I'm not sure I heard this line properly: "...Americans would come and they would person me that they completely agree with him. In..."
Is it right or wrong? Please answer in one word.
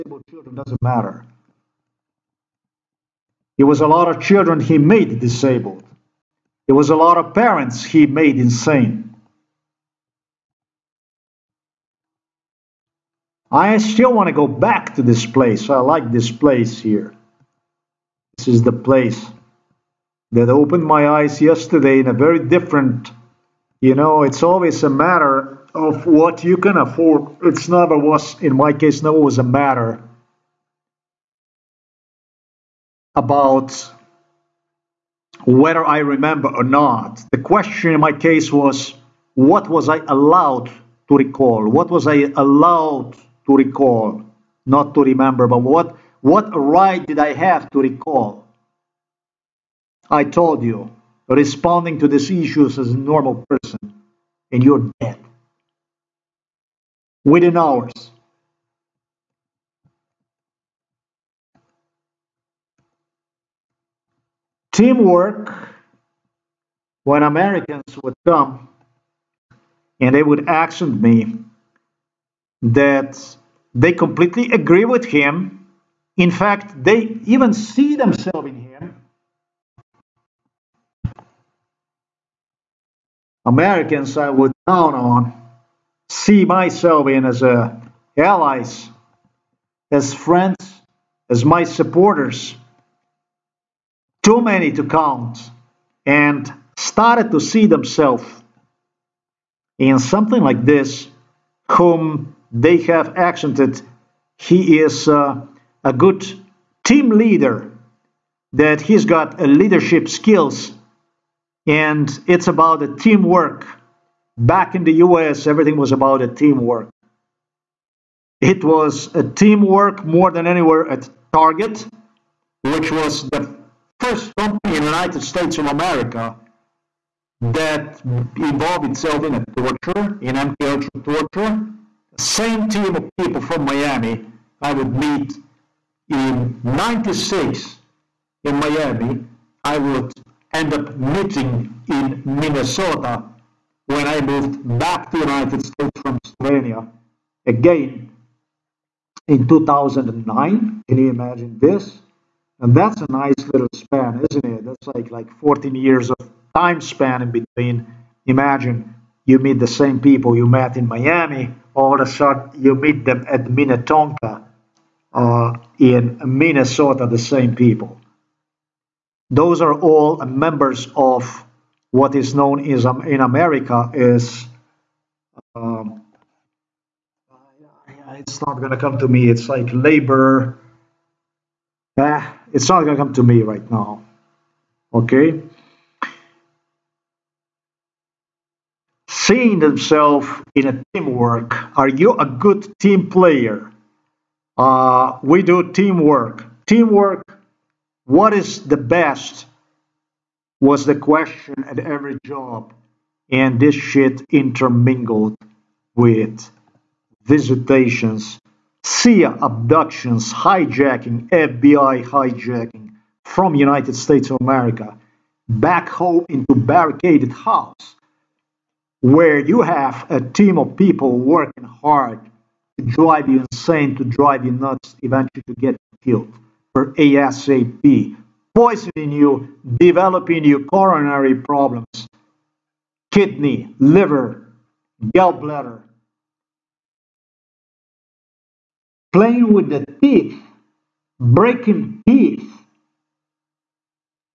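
wrong.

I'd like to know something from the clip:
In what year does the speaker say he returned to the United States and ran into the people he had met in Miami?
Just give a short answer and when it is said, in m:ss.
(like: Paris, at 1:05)
2009, at 2:29.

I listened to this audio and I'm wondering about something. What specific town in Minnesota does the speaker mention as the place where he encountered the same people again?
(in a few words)
Minnetonka.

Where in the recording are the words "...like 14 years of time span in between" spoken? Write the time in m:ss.
2:35.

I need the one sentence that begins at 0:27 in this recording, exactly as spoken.
It's never was, in my case, never was a matter about whether I remember or not.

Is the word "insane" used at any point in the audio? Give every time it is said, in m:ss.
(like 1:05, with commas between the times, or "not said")
0:08, 3:43.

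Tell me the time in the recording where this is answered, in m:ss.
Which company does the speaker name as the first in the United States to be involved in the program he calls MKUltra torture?
2:01.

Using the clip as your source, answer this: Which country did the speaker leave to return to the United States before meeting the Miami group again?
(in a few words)
Slovenia.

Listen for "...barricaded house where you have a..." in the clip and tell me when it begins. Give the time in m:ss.
3:36.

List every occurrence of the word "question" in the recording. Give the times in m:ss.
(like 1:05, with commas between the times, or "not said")
0:37, 3:20.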